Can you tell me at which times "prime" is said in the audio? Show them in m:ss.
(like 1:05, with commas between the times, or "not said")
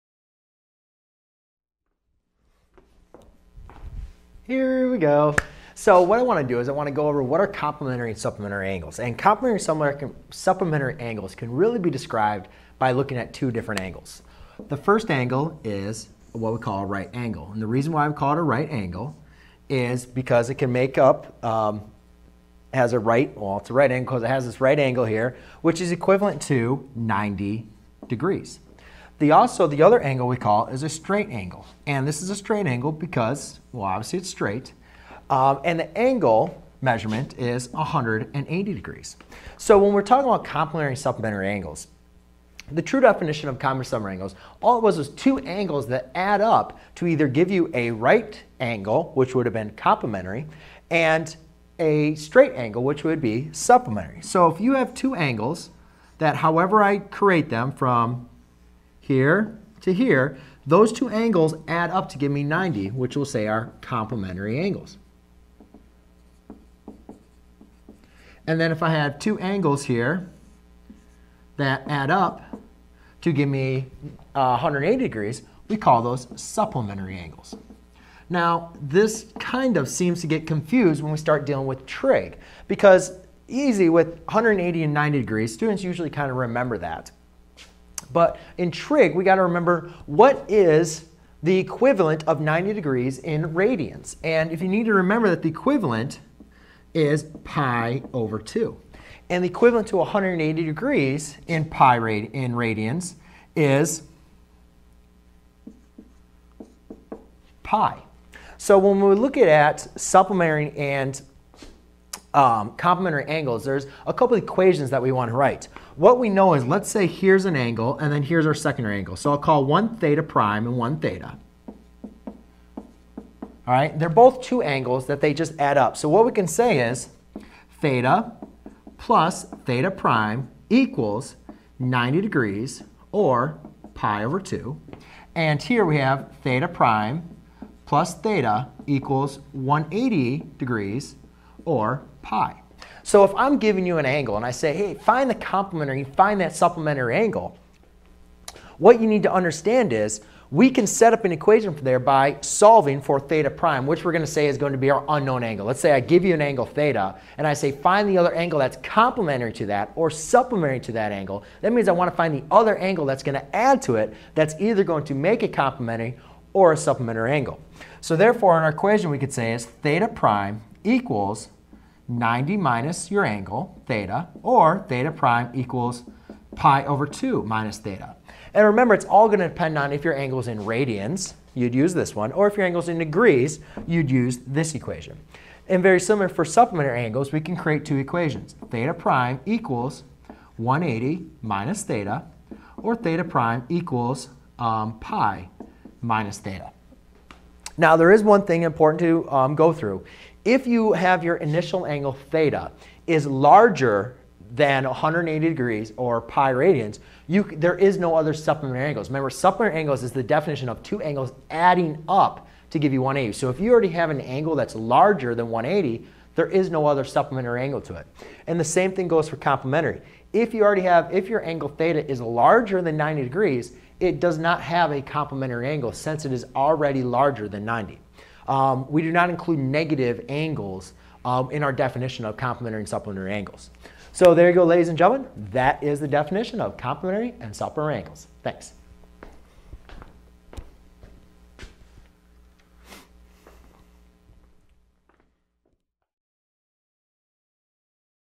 2:00, 2:09, 2:16, 2:33, 2:50, 2:55, 3:08, 3:13.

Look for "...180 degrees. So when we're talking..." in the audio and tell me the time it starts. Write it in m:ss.
0:37.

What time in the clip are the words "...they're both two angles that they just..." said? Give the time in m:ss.
2:03.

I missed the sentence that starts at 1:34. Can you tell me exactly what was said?
And if you need to remember that the equivalent is pi over 2.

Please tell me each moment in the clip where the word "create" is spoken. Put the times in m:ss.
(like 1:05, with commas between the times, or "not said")
0:56, 3:07.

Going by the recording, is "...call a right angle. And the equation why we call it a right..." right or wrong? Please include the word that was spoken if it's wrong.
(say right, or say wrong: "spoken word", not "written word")
wrong: "reason", not "equation".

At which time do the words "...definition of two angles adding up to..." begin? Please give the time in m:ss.
3:30.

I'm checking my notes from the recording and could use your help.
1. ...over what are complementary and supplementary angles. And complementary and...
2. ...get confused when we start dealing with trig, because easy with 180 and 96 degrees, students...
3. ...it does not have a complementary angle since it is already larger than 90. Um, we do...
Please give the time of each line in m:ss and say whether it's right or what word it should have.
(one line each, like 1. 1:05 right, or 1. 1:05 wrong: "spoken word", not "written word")
1. 0:07 right
2. 1:20 wrong: "90", not "96"
3. 3:43 right.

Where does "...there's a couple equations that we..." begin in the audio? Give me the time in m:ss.
1:53.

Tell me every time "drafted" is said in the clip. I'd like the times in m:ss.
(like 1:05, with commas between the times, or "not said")
not said.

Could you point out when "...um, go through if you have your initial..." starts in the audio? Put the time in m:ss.
3:19.